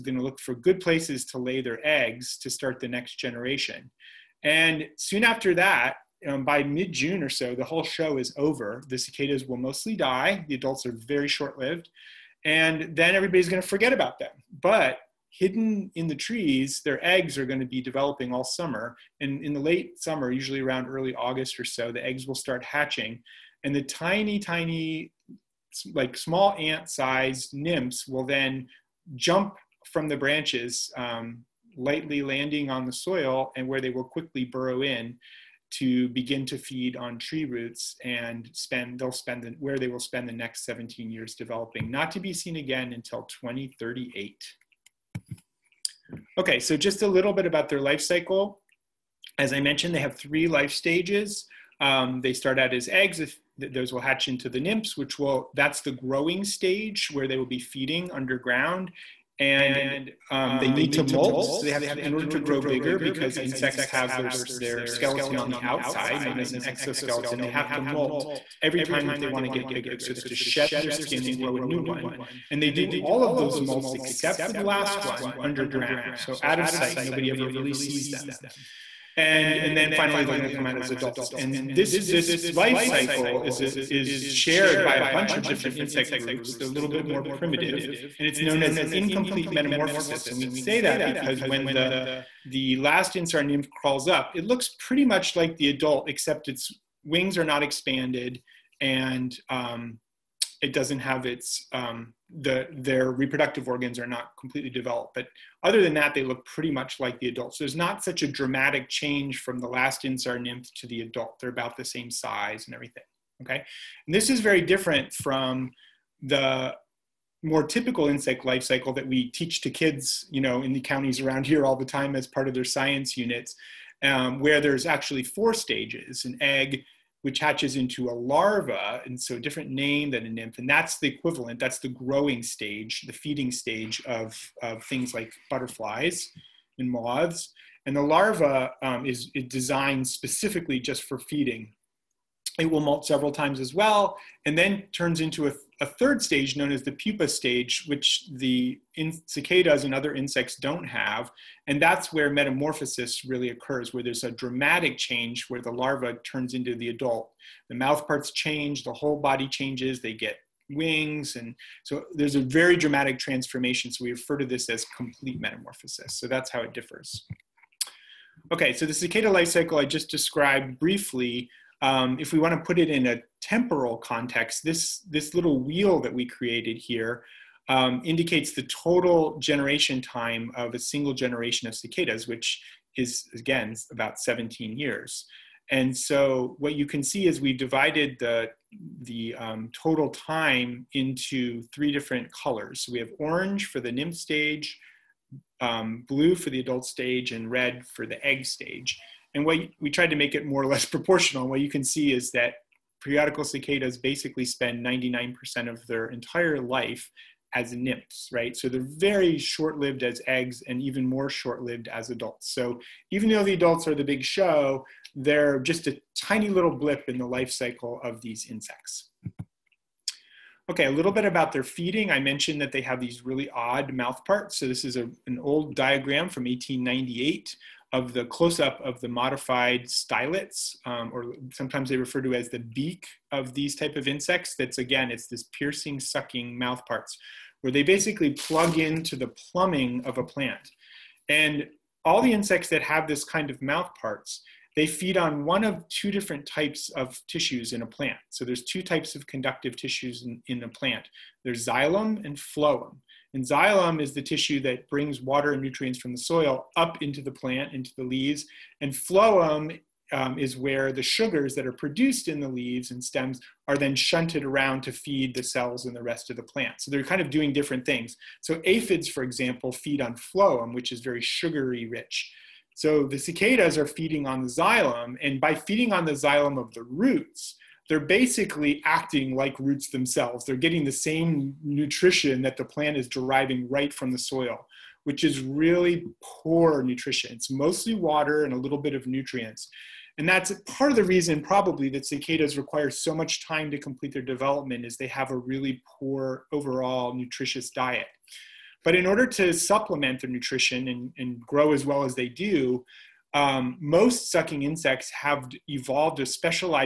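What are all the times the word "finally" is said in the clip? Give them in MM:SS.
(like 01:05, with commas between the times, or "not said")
01:19.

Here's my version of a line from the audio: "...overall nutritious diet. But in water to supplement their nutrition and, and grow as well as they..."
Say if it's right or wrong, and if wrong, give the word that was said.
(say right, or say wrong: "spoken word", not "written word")
wrong: "order", not "water".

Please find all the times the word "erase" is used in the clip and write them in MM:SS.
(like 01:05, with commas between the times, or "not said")
not said.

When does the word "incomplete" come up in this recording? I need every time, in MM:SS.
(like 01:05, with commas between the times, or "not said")
01:28.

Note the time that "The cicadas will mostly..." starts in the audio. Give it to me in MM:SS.
00:08.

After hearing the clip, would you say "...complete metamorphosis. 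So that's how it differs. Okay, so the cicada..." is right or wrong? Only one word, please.
right.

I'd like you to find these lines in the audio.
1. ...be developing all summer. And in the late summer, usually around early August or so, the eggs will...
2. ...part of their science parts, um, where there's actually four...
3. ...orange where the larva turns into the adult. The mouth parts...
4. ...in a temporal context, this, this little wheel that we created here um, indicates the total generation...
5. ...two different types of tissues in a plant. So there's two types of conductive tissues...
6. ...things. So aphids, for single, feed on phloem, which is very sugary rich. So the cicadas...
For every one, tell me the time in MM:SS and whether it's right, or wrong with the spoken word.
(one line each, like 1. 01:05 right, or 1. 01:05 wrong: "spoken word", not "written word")
1. 00:17 right
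2. 02:02 wrong: "units", not "parts"
3. 02:34 wrong: "change", not "orange"
4. 02:52 right
5. 04:05 right
6. 04:27 wrong: "example", not "single".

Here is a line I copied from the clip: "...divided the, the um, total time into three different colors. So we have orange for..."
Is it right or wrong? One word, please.
right.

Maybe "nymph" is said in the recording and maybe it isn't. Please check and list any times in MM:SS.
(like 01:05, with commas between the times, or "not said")
00:27, 00:54, 01:33, 01:50, 02:10, 03:13, 03:27.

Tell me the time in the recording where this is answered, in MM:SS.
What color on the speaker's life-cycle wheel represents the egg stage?
03:17.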